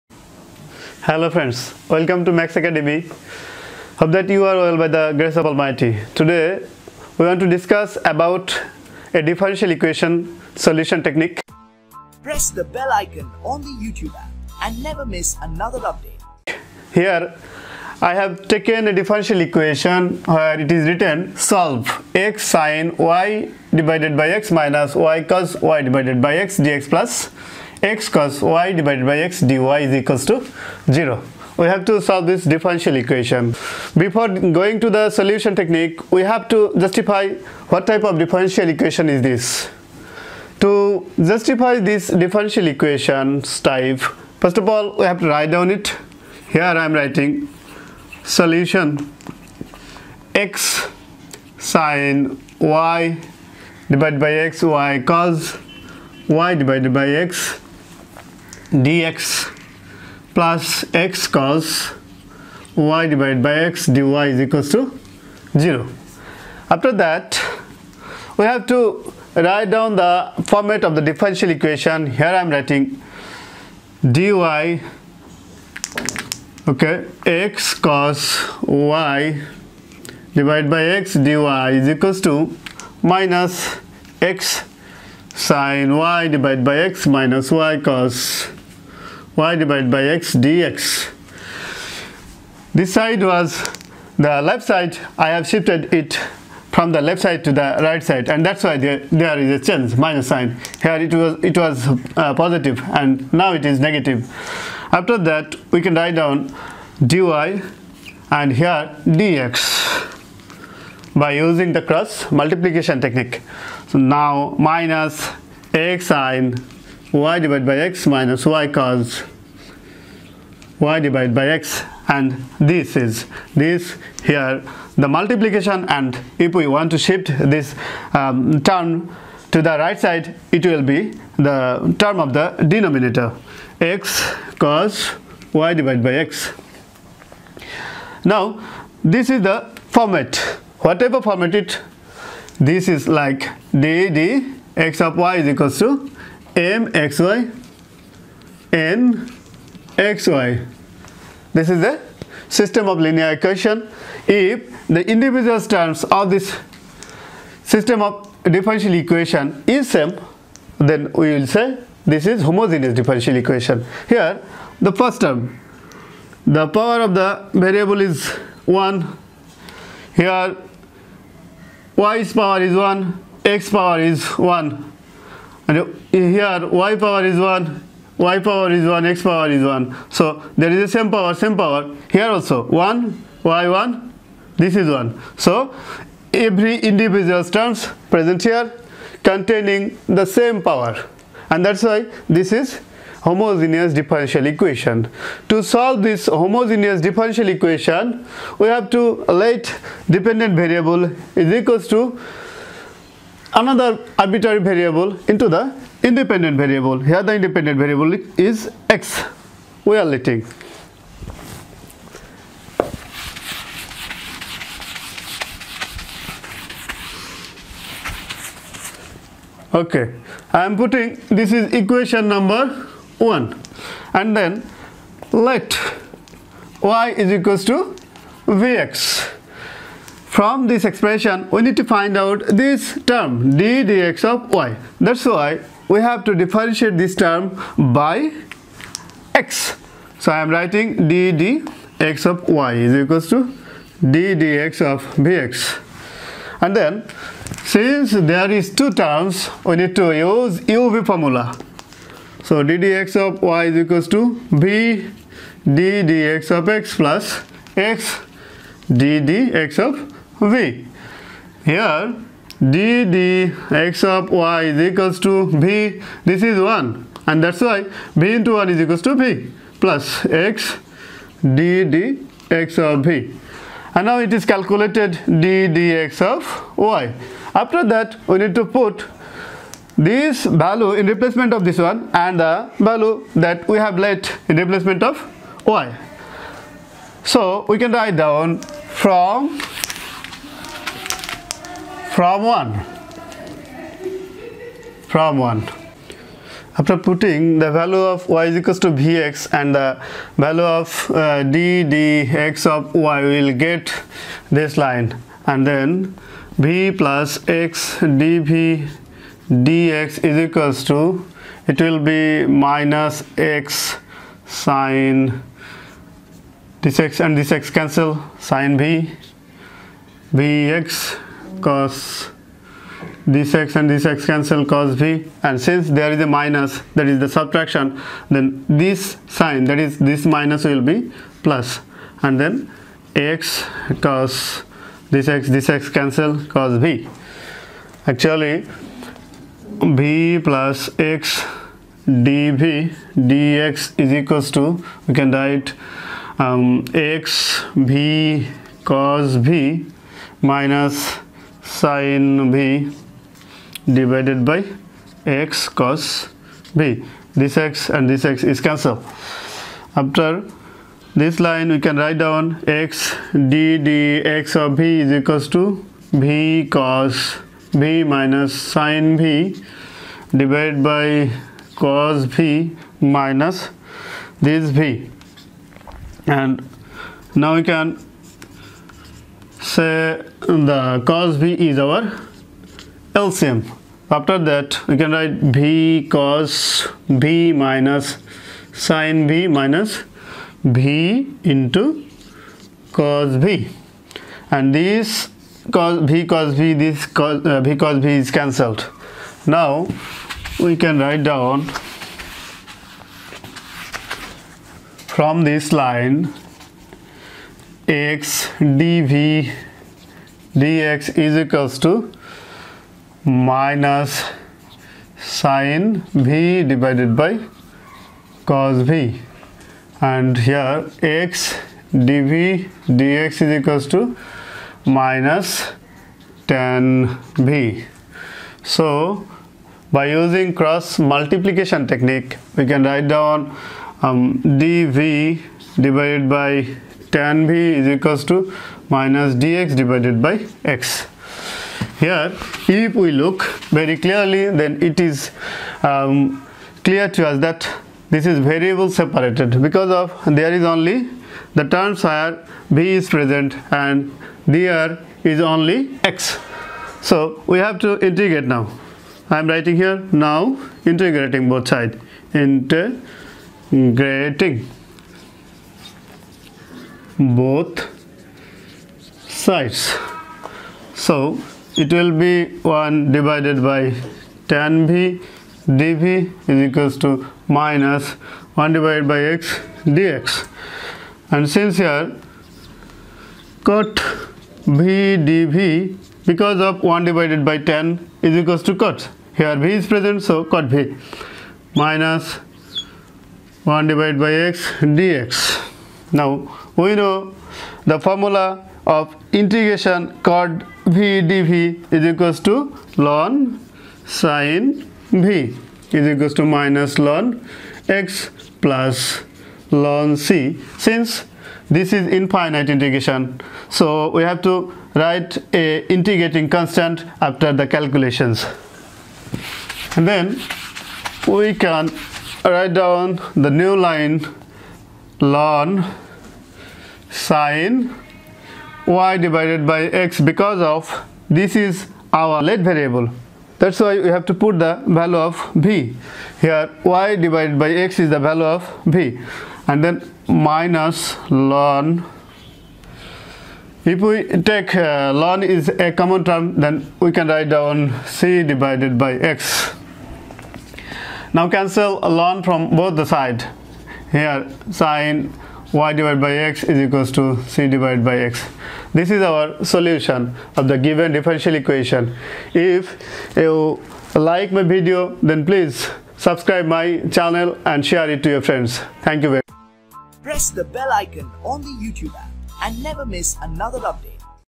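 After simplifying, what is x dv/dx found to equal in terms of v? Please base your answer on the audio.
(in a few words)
minus tan v.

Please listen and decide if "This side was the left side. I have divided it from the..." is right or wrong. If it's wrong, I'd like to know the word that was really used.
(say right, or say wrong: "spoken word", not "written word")
wrong: "shifted", not "divided".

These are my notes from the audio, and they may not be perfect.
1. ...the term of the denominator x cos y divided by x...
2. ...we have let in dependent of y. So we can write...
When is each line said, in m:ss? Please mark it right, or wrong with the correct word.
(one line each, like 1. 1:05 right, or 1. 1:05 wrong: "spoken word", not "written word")
1. 2:11 right
2. 4:43 wrong: "replacement", not "dependent".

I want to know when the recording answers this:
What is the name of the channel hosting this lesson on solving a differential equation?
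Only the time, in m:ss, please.
0:02.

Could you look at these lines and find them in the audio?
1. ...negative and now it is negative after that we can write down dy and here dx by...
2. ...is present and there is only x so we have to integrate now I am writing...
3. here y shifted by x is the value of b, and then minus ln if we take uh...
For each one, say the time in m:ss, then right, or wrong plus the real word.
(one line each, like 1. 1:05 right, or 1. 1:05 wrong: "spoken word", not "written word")
1. 1:42 wrong: "positive", not "negative"
2. 7:32 right
3. 8:56 wrong: "divided", not "shifted".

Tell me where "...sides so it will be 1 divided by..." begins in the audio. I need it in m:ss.
7:49.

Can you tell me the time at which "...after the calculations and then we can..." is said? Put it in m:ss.
8:37.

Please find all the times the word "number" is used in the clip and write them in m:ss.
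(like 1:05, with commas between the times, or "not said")
3:42.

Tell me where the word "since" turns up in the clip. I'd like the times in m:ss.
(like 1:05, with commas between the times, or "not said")
4:07, 5:25, 8:01, 8:30.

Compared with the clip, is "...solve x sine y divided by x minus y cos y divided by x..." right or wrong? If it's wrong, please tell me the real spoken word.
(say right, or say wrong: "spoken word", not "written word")
right.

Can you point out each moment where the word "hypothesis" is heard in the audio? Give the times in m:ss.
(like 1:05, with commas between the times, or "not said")
not said.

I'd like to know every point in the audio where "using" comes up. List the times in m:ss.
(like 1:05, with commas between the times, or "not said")
1:51, 7:10.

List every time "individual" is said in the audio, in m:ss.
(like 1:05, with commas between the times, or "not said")
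2:35, 3:06.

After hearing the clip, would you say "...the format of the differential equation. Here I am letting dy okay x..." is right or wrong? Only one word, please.
wrong.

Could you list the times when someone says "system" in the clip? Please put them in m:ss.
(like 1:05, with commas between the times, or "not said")
2:32, 2:37.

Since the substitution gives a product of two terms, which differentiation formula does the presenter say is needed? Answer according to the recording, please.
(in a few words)
uv formula.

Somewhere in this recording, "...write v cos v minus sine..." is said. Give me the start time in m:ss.
6:25.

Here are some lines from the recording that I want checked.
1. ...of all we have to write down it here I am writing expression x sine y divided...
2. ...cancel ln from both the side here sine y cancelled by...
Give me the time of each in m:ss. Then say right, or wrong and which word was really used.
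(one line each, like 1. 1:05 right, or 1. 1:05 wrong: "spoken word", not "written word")
1. 0:44 wrong: "solution", not "expression"
2. 9:11 wrong: "divided", not "cancelled".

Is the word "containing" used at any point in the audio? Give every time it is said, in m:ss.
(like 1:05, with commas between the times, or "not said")
3:09.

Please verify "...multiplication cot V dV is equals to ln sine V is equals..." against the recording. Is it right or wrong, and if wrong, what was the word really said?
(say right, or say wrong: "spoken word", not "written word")
wrong: "integration", not "multiplication".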